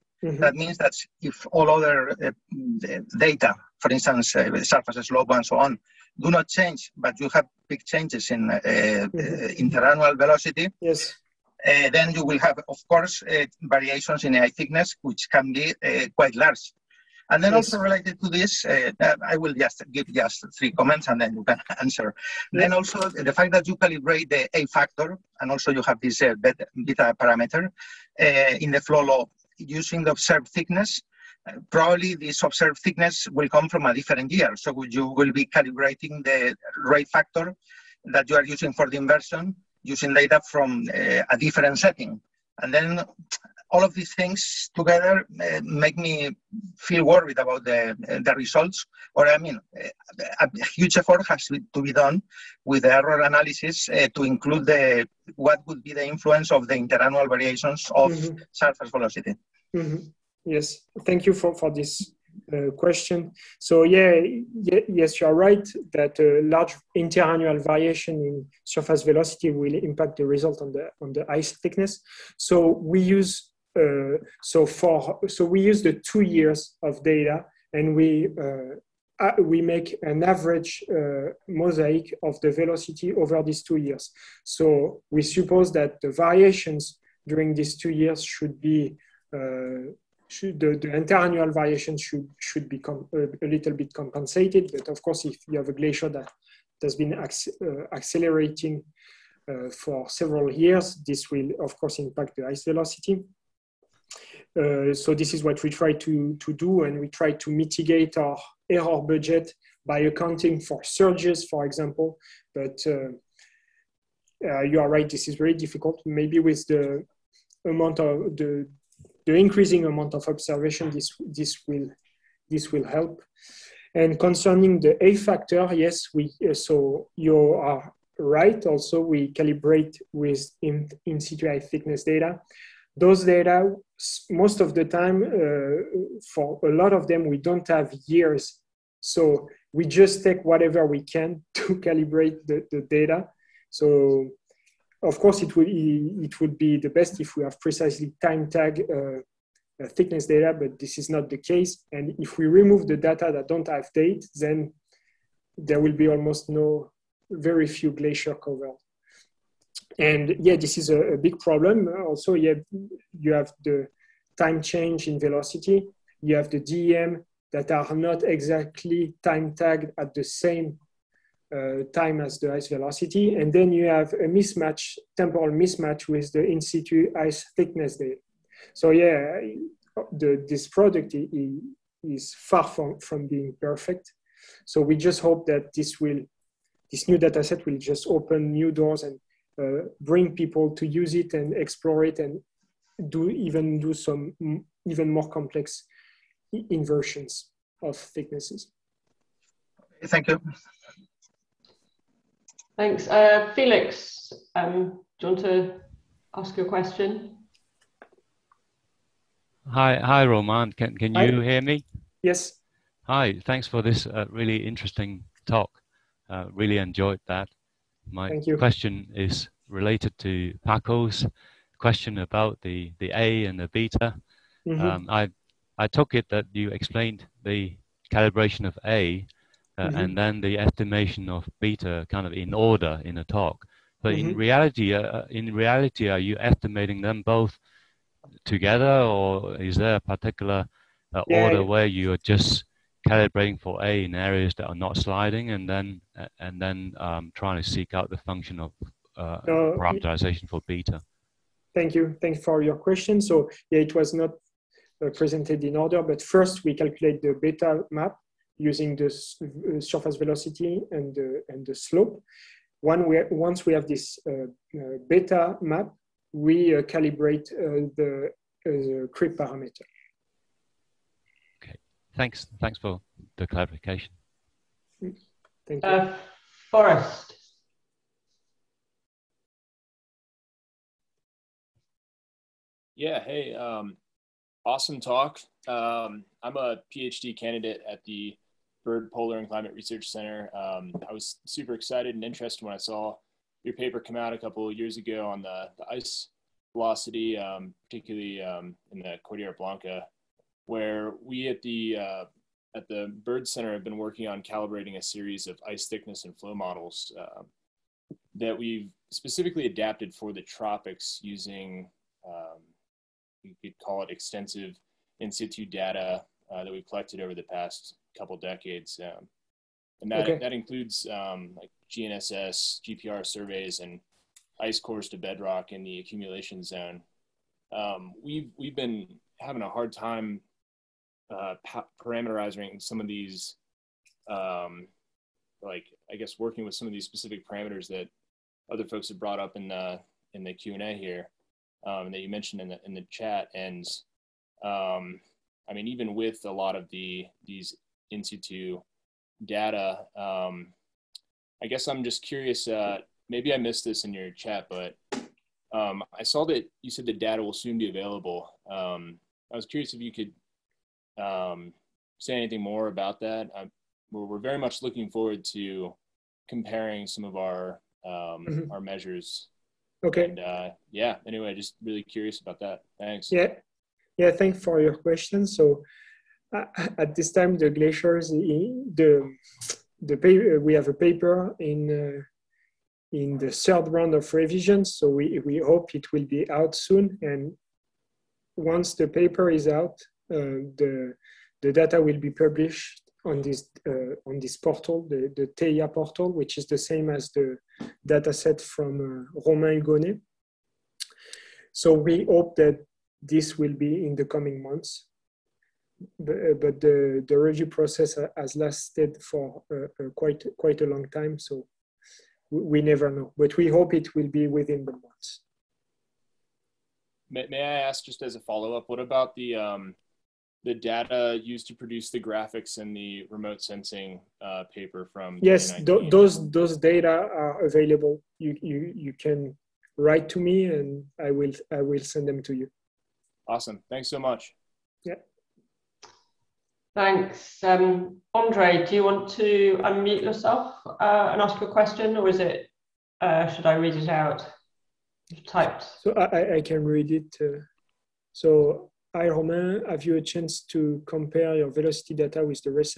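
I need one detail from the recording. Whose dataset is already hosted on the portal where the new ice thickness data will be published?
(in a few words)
Romain Hugonnet.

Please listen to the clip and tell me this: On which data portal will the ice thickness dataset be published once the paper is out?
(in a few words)
Theia.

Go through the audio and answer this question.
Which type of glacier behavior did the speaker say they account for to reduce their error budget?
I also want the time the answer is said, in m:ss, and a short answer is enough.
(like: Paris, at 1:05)
Surges, at 1:50.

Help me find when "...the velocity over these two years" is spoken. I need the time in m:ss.
1:22.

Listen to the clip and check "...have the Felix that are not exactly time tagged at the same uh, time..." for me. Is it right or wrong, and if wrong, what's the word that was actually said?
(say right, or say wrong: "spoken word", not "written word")
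wrong: "DEM", not "Felix".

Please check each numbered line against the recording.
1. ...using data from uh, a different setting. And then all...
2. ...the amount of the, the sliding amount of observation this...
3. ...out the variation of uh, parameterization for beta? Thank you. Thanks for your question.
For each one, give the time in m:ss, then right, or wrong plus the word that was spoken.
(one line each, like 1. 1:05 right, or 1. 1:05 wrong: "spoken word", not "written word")
1. 0:39 right
2. 1:56 wrong: "increasing", not "sliding"
3. 4:07 wrong: "function", not "variation".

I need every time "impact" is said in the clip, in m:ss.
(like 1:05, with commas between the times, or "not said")
1:09, 1:41.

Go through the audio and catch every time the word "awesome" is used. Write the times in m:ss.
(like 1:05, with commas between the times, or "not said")
4:44, 7:13.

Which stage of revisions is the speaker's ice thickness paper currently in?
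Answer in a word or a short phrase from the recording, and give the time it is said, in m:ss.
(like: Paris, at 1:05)
Third round, at 6:23.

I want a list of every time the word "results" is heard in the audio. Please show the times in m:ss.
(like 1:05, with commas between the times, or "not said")
0:48, 1:10.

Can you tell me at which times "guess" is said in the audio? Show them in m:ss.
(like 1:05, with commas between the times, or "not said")
5:36, 5:51.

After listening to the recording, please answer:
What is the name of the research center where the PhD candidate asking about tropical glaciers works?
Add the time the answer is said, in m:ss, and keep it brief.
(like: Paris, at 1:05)
Byrd Polar and Climate Research Center, at 4:48.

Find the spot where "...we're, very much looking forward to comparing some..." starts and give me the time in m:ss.
6:04.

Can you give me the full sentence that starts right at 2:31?
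And if we remove the data that don't have date, then there will be almost no, very few glacier cover.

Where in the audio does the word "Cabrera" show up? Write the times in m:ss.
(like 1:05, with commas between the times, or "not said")
not said.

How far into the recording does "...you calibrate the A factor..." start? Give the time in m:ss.
0:23.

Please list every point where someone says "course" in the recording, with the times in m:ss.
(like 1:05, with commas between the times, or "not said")
0:12, 1:35, 1:41, 2:25.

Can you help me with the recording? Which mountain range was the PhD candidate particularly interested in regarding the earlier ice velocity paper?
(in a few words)
Cordillera Blanca.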